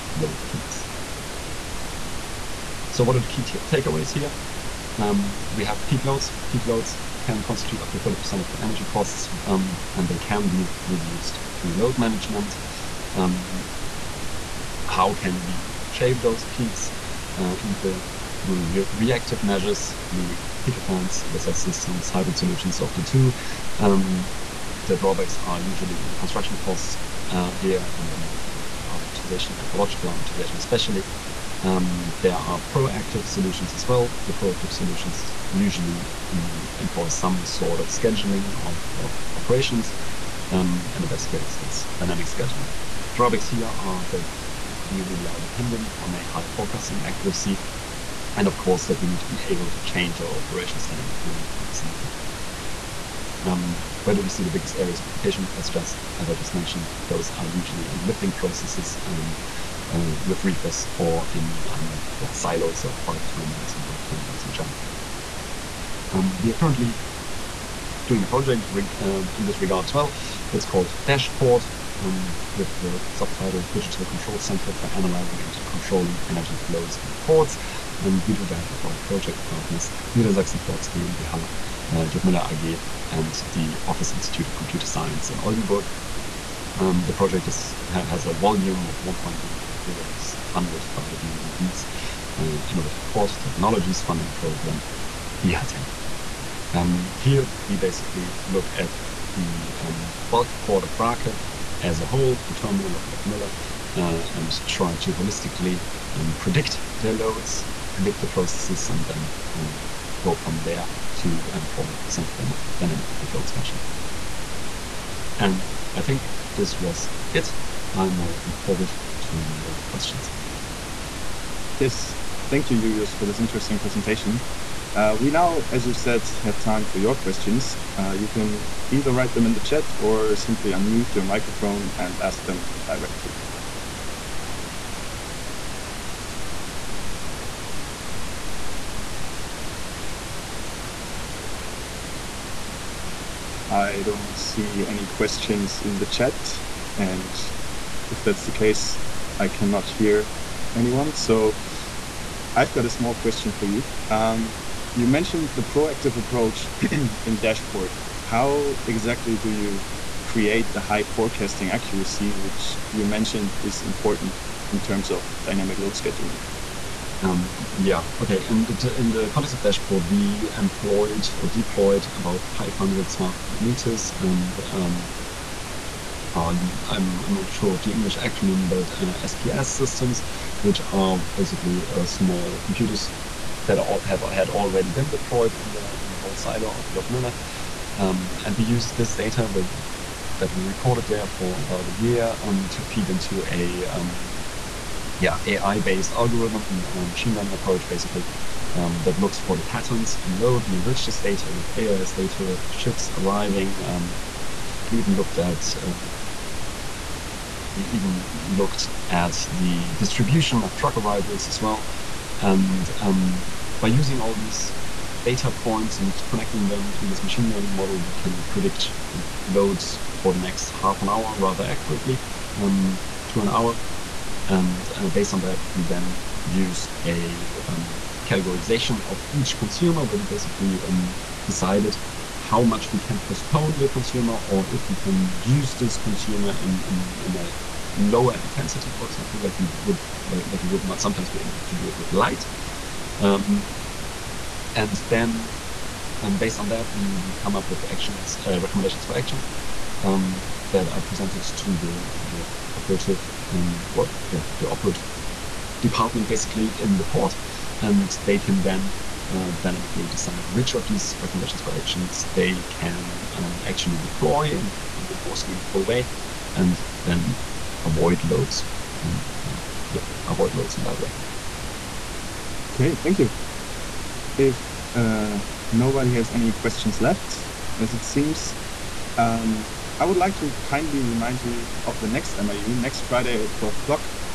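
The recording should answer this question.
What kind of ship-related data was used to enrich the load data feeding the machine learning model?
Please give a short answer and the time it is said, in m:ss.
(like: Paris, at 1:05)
AIS data, at 3:21.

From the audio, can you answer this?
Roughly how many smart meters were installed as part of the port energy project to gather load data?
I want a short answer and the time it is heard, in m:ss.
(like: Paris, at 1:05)
500, at 2:52.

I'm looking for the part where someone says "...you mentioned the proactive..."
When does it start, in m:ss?
2:34.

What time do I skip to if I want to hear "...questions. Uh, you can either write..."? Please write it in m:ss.
2:07.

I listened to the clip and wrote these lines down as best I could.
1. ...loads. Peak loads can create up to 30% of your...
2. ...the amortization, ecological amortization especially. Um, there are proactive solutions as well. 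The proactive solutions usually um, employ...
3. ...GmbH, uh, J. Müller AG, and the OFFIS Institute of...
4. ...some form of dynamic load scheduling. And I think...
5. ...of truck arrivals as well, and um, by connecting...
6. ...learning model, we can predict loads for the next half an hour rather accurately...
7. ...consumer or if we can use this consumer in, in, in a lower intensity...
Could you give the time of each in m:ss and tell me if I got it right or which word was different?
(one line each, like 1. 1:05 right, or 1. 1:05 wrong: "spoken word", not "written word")
1. 0:06 wrong: "constitute", not "create"
2. 0:28 right
3. 1:20 right
4. 1:52 right
5. 3:30 wrong: "using", not "connecting"
6. 3:37 right
7. 3:53 right.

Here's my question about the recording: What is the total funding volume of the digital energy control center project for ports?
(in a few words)
1.1 million euro.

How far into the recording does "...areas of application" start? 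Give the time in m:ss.
0:54.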